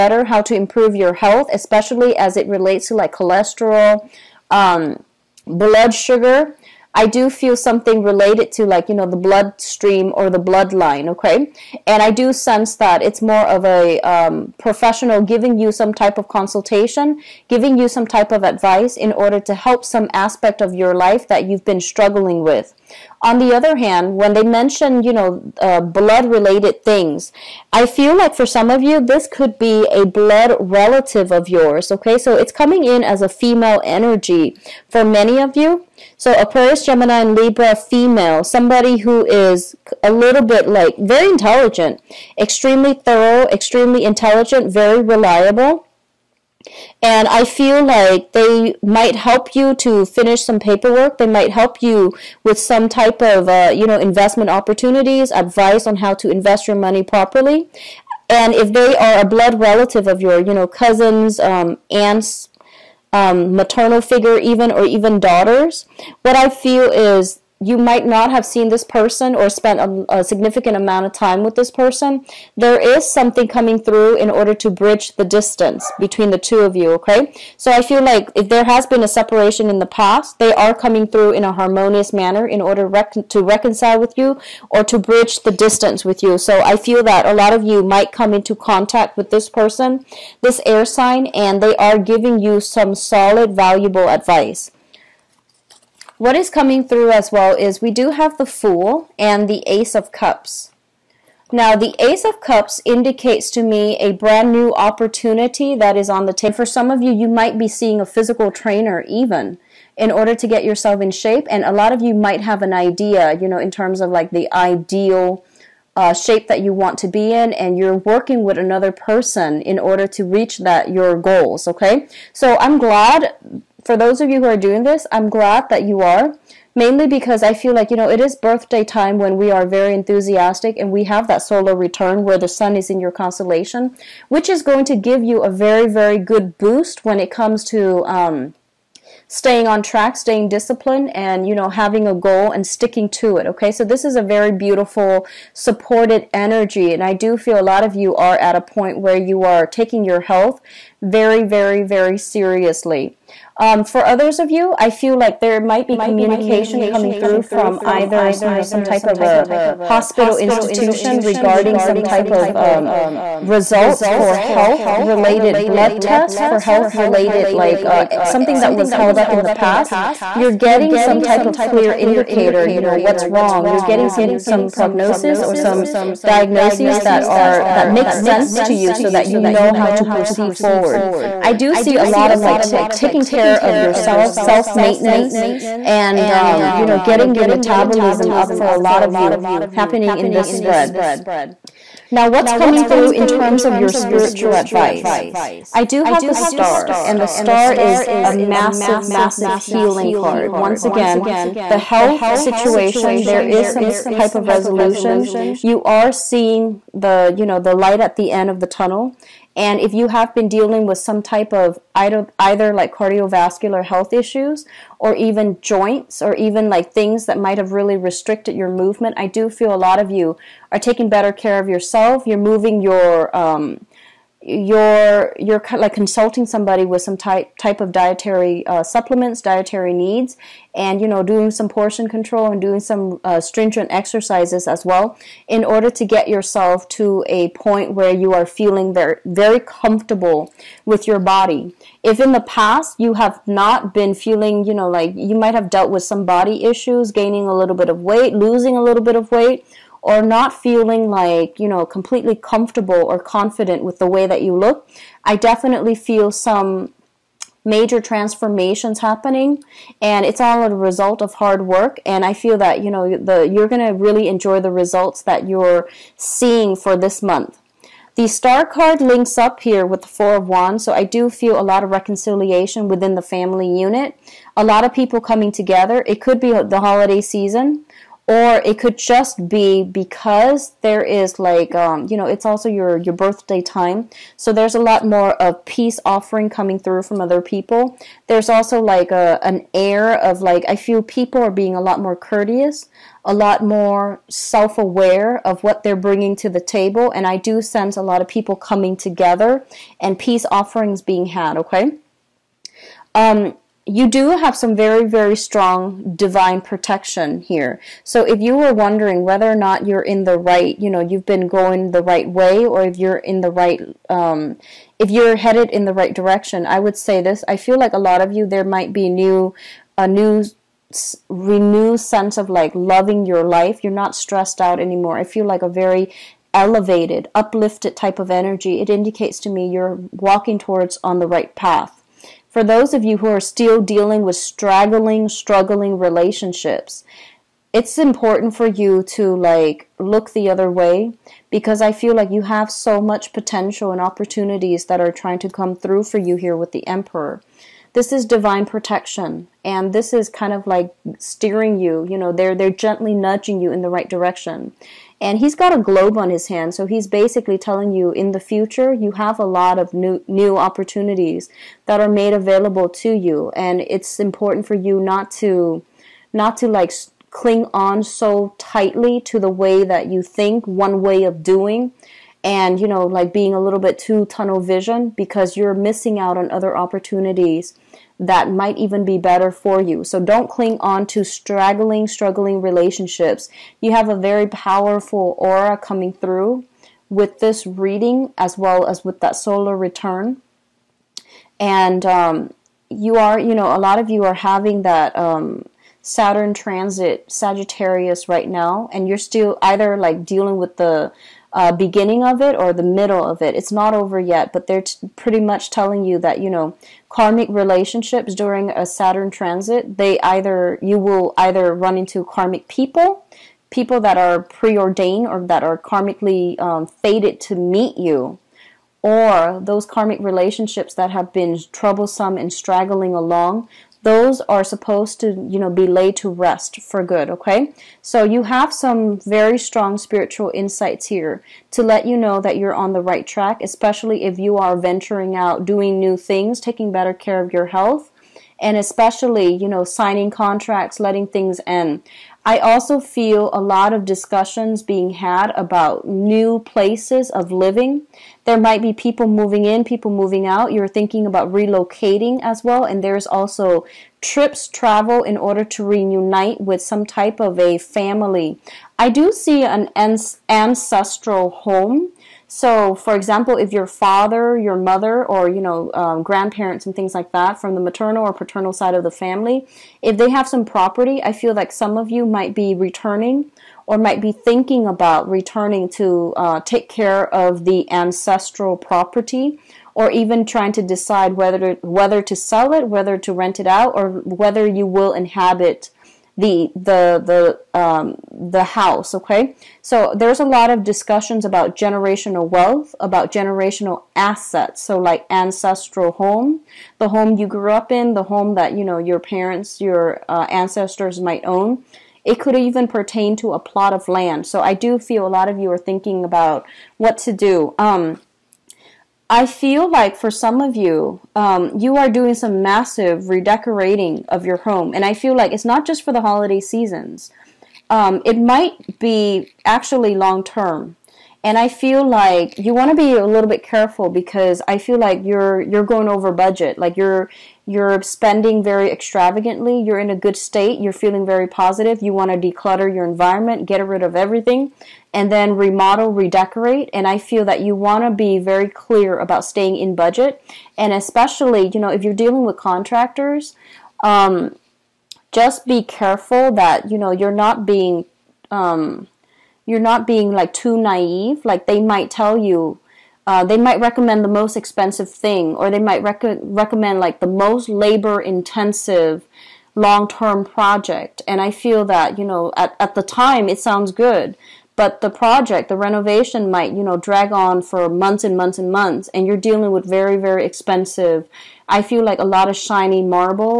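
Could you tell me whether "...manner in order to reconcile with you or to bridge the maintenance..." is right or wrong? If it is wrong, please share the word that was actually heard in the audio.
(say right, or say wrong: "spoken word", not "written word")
wrong: "distance", not "maintenance".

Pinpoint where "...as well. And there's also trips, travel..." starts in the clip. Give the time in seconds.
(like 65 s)
452 s.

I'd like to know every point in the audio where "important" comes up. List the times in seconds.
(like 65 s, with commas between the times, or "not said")
337 s, 364 s.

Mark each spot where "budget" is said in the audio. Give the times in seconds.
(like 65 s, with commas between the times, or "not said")
526 s, 539 s.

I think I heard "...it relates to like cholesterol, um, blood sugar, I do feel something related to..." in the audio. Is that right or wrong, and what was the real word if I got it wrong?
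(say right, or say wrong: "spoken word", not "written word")
right.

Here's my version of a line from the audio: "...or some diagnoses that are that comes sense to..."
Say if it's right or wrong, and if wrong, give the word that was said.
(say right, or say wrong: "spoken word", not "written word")
wrong: "makes", not "comes".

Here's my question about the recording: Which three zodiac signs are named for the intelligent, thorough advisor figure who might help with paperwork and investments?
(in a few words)
Aquarius, Gemini, and Libra.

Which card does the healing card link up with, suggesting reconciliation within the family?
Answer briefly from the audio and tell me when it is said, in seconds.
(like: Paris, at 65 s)
Four of Wands, at 270 s.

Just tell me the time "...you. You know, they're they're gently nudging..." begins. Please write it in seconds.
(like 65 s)
351 s.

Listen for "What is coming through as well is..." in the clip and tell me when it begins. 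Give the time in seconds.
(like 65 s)
96 s.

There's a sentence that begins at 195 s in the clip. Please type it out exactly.
I do have the star, and the star is a massive, massive healing card.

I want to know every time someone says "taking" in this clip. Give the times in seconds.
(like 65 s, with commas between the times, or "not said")
149 s, 182 s, 220 s, 436 s.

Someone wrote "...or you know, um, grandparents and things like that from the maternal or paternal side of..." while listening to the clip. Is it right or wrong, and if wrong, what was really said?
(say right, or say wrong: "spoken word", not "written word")
right.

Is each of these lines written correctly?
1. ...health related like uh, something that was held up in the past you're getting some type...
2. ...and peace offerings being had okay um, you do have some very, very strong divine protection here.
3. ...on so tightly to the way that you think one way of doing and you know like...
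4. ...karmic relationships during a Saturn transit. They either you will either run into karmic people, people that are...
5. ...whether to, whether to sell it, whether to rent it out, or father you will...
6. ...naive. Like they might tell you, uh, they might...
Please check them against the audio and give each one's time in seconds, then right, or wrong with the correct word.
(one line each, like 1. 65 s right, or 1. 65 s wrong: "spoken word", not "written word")
1. 166 s right
2. 299 s right
3. 367 s right
4. 407 s right
5. 481 s wrong: "whether", not "father"
6. 550 s right.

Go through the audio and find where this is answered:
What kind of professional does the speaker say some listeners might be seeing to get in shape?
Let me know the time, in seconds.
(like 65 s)
108 s.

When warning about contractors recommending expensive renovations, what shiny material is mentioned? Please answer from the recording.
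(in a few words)
Marble.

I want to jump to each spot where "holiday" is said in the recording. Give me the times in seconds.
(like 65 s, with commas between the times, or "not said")
276 s, 516 s.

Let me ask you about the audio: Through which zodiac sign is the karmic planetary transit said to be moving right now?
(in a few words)
Sagittarius.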